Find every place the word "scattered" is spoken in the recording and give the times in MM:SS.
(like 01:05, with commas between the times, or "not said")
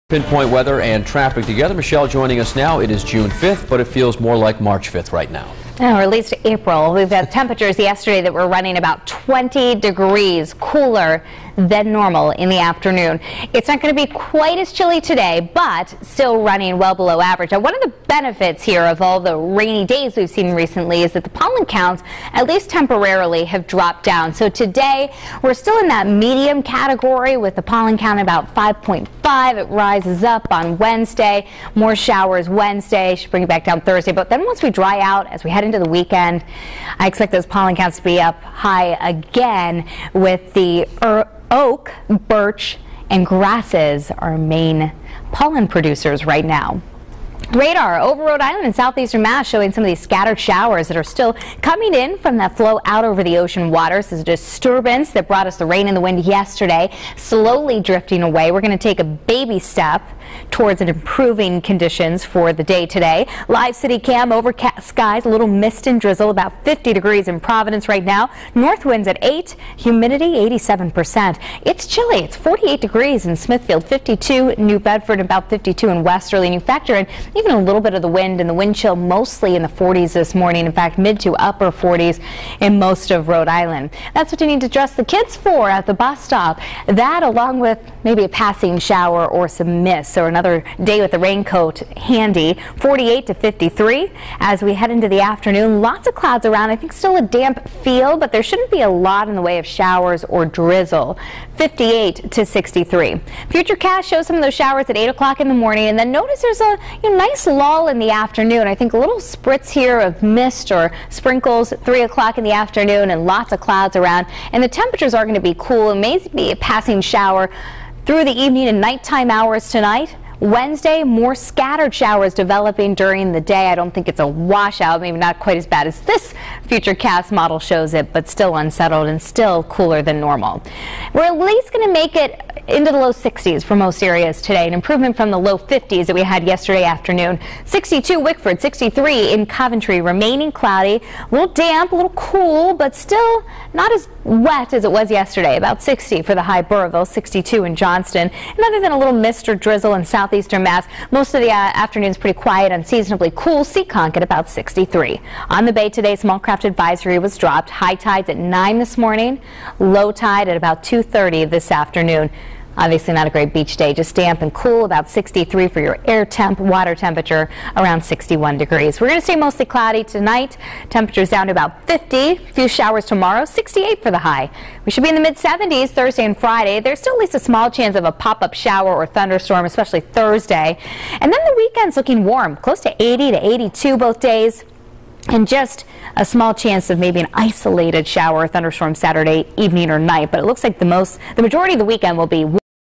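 00:49, 02:01.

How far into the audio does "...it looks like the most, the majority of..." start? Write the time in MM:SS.
03:10.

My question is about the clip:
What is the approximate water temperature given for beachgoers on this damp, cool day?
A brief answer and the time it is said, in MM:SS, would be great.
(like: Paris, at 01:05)
61 degrees, at 02:48.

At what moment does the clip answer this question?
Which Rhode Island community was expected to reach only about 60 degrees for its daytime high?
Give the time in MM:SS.
02:26.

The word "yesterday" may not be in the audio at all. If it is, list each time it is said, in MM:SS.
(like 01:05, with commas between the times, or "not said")
00:07, 00:56, 02:16, 02:25.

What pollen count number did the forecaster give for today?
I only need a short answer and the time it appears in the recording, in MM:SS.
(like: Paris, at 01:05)
5.5, at 00:28.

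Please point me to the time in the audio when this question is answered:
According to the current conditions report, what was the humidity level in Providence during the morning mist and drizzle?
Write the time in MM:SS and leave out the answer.
01:10.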